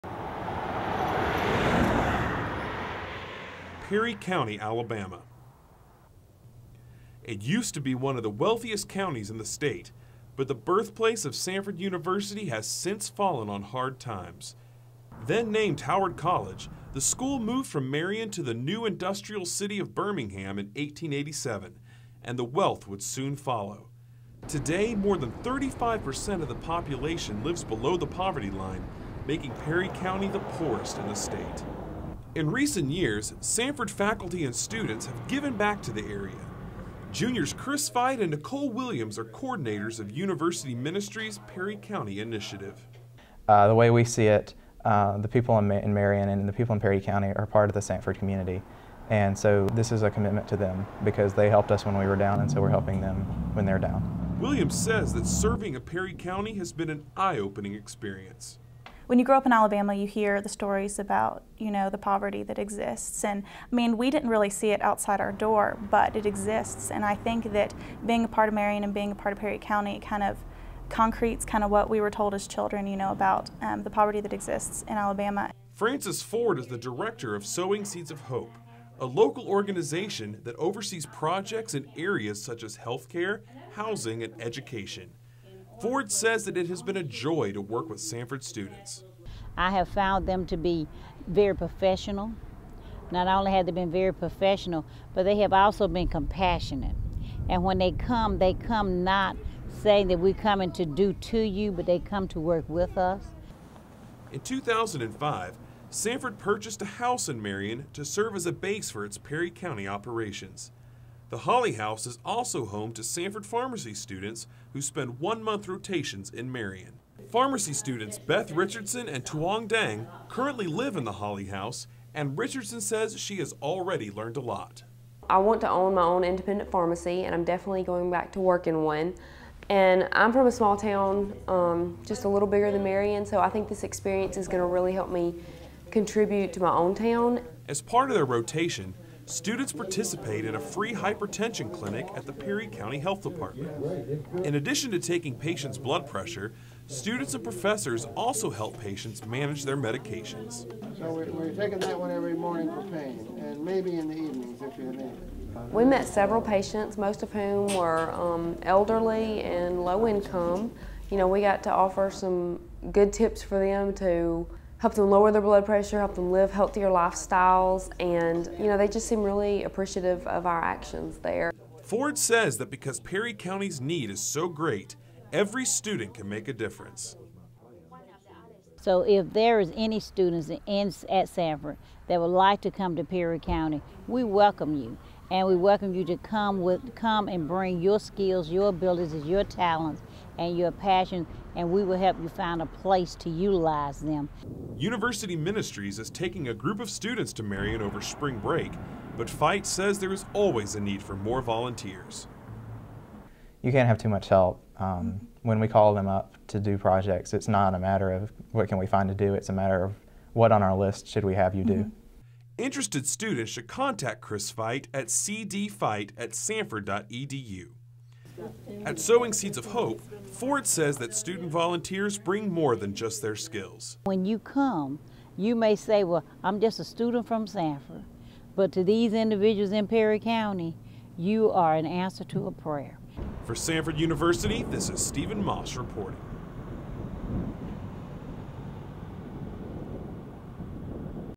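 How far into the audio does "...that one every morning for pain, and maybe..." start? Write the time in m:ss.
2:31.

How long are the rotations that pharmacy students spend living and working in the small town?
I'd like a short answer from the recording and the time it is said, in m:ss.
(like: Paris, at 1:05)
one month, at 1:55.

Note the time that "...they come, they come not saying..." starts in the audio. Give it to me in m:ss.
1:37.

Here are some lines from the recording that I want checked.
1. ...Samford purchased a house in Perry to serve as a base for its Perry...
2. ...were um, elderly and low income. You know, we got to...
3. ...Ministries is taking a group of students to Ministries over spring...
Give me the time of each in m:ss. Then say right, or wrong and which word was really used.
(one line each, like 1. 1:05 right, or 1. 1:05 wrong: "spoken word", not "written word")
1. 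1:45 wrong: "Marion", not "Perry"
2. 2:37 right
3. 3:15 wrong: "Marion", not "Ministries".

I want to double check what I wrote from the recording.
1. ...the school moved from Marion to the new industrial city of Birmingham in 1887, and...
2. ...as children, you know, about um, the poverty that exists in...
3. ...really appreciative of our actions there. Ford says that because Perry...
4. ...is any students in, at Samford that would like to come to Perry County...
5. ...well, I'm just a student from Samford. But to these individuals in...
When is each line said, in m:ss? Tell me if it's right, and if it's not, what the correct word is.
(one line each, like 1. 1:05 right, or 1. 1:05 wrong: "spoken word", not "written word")
1. 0:16 right
2. 1:12 right
3. 2:49 right
4. 2:59 right
5. 3:46 right.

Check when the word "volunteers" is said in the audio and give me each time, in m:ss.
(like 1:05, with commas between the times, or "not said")
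3:21, 3:41.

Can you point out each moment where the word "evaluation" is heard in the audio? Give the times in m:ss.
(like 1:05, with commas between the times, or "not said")
not said.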